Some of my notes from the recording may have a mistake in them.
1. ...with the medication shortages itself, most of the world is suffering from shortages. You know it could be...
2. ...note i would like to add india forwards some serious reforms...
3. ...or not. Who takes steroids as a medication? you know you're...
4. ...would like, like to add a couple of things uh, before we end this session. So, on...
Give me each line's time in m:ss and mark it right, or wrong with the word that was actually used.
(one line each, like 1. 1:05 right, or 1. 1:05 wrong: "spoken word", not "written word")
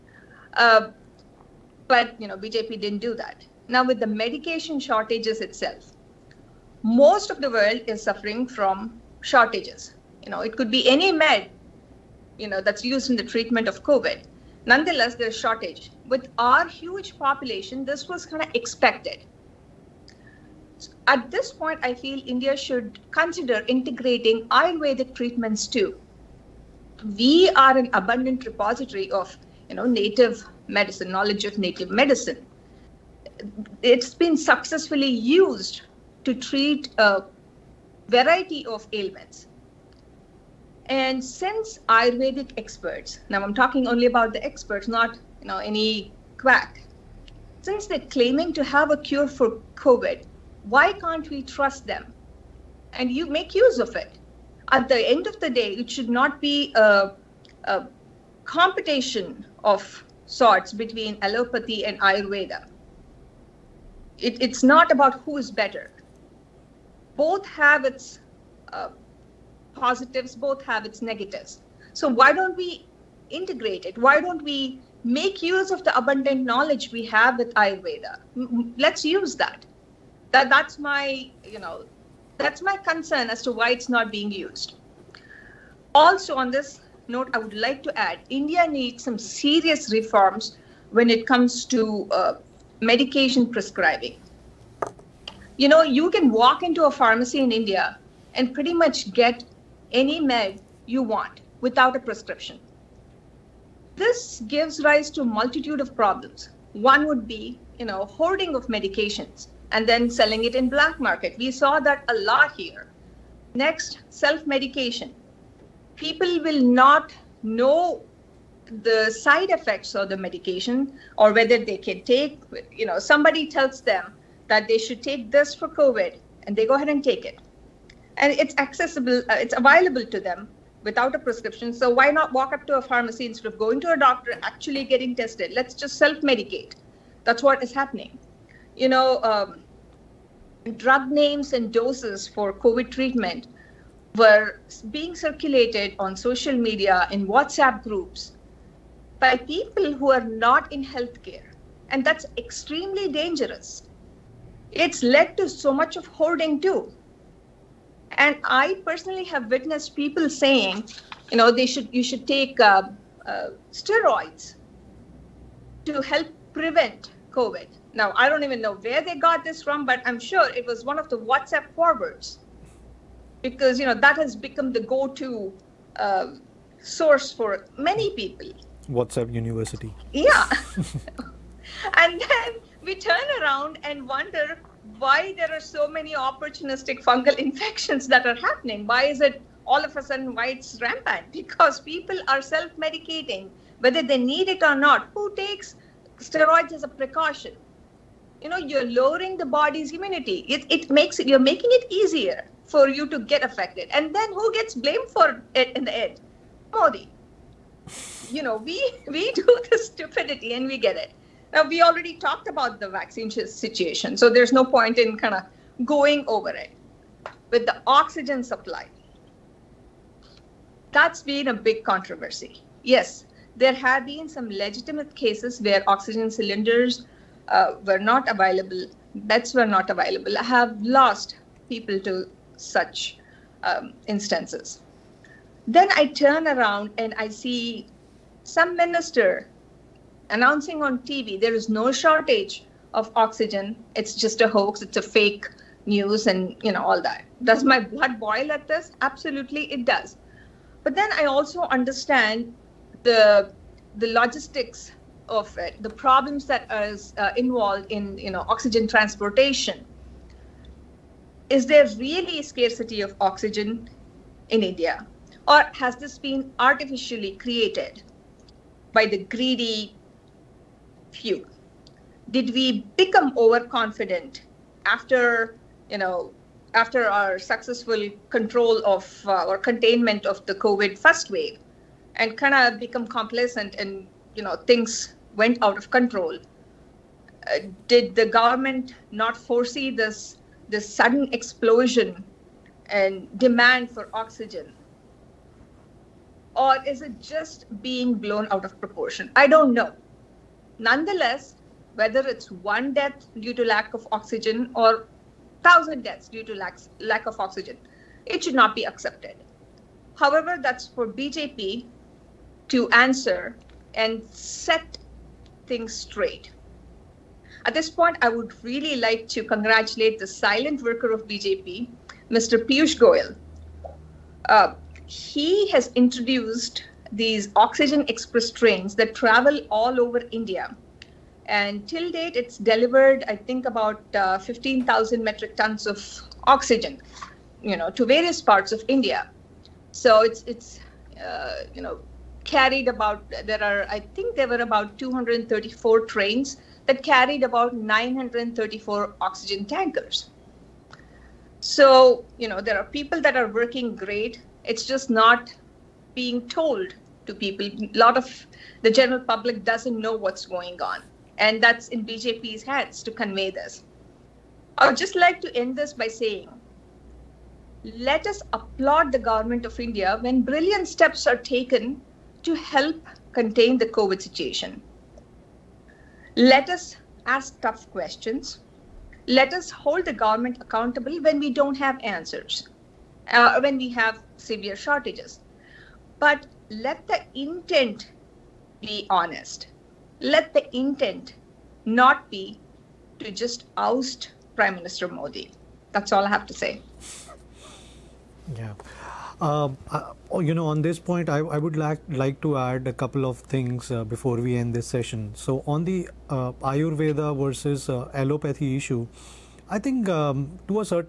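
1. 0:03 right
2. 1:27 wrong: "needs", not "forwards"
3. 3:14 wrong: "precaution", not "medication"
4. 6:41 right.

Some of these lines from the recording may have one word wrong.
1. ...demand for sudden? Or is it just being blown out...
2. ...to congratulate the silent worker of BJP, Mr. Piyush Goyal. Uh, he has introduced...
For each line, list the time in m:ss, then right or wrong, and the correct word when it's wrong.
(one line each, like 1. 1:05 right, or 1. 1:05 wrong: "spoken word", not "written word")
1. 4:53 wrong: "oxygen", not "sudden"
2. 5:19 right.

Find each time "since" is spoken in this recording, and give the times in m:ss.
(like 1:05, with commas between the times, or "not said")
0:41, 0:47.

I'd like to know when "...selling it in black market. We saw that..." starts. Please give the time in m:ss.
1:50.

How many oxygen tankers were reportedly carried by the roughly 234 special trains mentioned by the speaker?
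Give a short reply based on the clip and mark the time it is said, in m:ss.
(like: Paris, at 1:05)
934, at 5:47.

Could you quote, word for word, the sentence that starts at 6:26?
But let the intent be honest.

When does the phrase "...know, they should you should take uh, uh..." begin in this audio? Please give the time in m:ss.
2:41.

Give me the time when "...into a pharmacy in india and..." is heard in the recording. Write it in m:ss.
1:36.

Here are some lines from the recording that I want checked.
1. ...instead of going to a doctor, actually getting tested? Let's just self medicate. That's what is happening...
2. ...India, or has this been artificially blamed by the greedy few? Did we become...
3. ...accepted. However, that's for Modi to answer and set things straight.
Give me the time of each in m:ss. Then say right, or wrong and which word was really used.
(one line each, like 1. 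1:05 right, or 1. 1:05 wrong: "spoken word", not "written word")
1. 2:13 right
2. 4:24 wrong: "created", not "blamed"
3. 5:08 wrong: "BJP", not "Modi".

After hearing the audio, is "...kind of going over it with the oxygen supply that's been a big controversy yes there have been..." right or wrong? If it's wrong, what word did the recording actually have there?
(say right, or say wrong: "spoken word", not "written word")
right.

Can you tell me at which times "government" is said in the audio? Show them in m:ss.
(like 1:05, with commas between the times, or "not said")
4:48, 6:09, 6:20.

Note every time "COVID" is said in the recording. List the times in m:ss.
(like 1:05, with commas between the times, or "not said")
0:13, 0:49, 2:05, 2:22, 2:47, 4:40, 6:13.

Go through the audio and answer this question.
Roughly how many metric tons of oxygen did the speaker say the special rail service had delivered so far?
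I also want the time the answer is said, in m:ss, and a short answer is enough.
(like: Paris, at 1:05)
15,000, at 5:34.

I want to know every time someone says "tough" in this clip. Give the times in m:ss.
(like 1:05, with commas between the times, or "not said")
6:17.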